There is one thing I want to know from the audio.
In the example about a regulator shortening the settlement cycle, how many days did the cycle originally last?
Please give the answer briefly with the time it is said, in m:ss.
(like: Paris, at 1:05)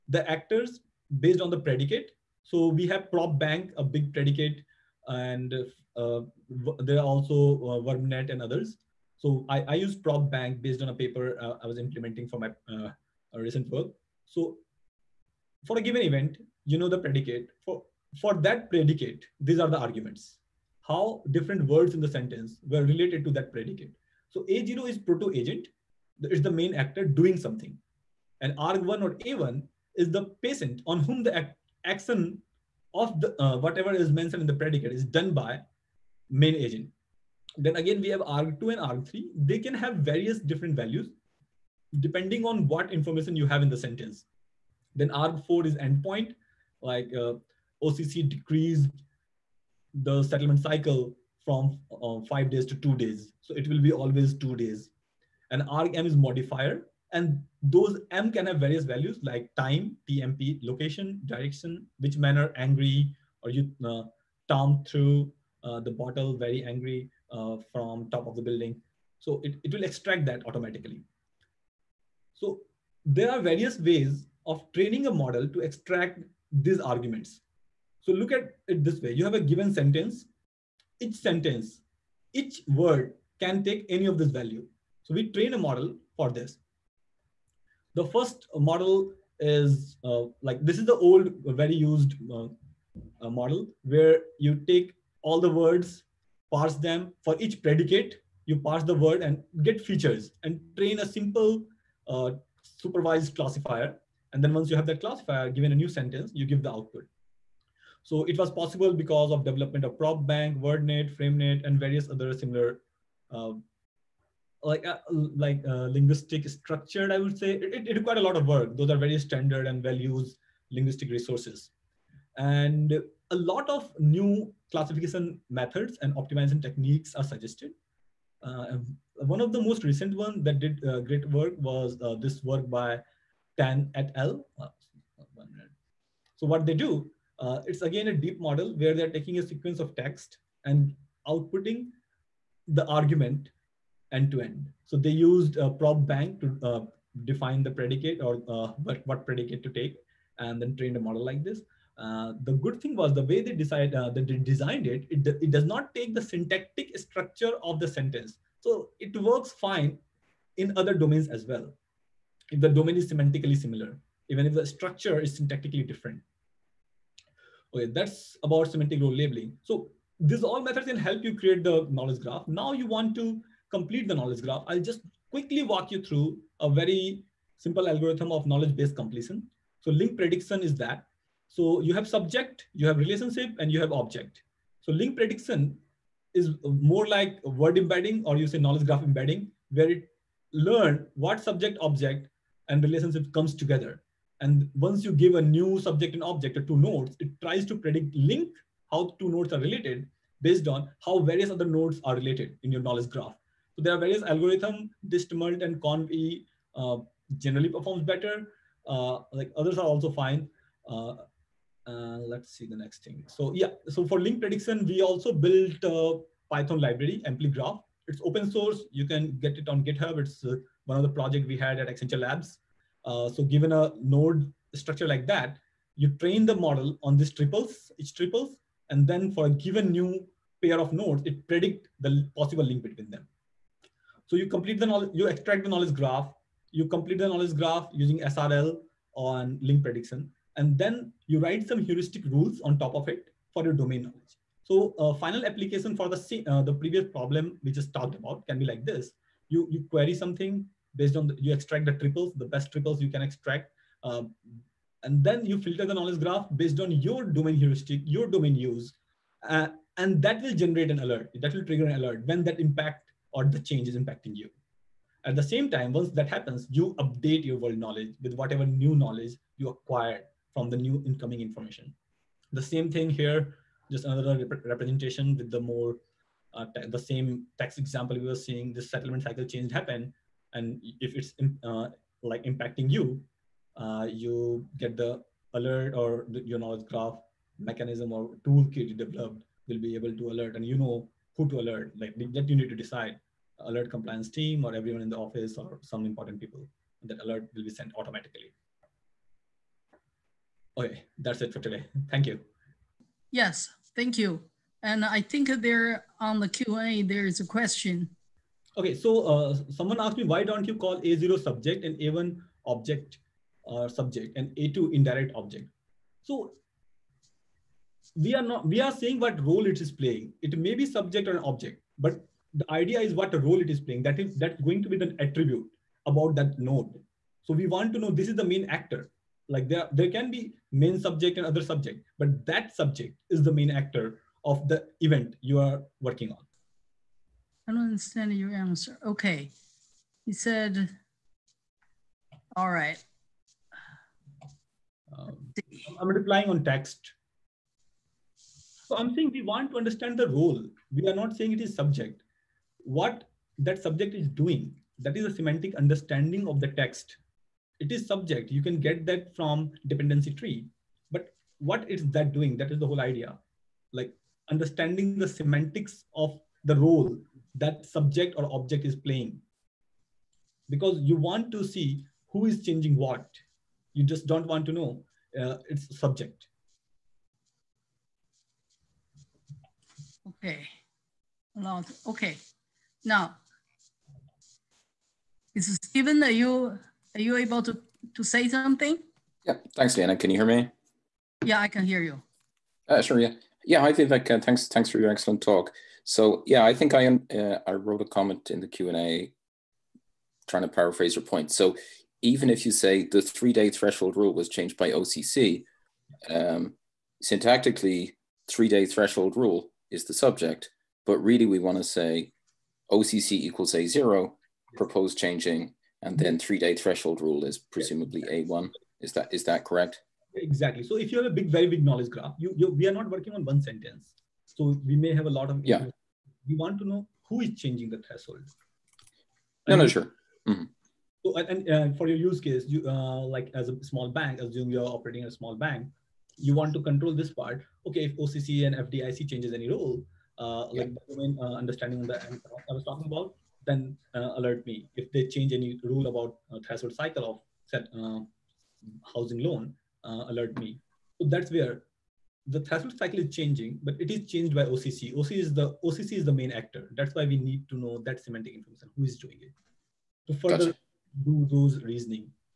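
5 days, at 0:52.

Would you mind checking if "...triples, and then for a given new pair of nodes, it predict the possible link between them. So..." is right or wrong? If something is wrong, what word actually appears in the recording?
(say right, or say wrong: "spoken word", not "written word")
right.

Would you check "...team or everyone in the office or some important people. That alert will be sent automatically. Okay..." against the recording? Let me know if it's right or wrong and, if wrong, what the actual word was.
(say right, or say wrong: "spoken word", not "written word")
right.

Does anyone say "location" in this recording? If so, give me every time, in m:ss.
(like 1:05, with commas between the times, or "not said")
1:00.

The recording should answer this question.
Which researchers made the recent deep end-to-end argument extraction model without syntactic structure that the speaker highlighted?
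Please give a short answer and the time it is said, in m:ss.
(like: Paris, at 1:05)
Tan et al., at 2:13.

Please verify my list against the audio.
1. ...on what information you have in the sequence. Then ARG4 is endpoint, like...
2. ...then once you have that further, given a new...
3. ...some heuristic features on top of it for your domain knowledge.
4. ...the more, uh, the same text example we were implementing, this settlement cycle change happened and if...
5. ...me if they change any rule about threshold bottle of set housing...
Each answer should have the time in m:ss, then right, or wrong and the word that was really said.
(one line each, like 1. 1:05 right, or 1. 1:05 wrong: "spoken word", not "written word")
1. 0:42 wrong: "sentence", not "sequence"
2. 1:44 wrong: "classifier", not "further"
3. 4:01 wrong: "rules", not "features"
4. 4:35 wrong: "seeing", not "implementing"
5. 7:24 wrong: "cycle", not "bottle".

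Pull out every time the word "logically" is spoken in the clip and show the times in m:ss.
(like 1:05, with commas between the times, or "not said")
not said.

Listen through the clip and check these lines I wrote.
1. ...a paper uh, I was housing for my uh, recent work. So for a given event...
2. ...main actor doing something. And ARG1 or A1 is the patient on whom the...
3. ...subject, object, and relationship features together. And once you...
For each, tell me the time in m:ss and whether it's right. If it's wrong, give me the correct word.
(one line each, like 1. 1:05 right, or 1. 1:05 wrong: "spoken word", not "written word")
1. 0:10 wrong: "implementing", not "housing"
2. 0:26 right
3. 3:11 wrong: "comes", not "features".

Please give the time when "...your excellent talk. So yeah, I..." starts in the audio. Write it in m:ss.
6:34.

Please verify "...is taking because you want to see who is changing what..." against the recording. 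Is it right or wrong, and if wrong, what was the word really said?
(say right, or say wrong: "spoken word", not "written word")
wrong: "playing", not "taking".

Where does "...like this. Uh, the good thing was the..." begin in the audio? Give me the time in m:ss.
2:31.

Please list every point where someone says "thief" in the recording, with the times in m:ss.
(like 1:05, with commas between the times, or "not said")
not said.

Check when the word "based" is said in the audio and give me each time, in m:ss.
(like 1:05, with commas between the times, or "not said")
0:01, 0:10, 2:58, 3:20, 4:10, 4:16.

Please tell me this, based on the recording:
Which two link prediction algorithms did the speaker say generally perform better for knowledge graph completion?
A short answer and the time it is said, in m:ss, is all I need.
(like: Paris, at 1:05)
DistMult and ConvE, at 3:25.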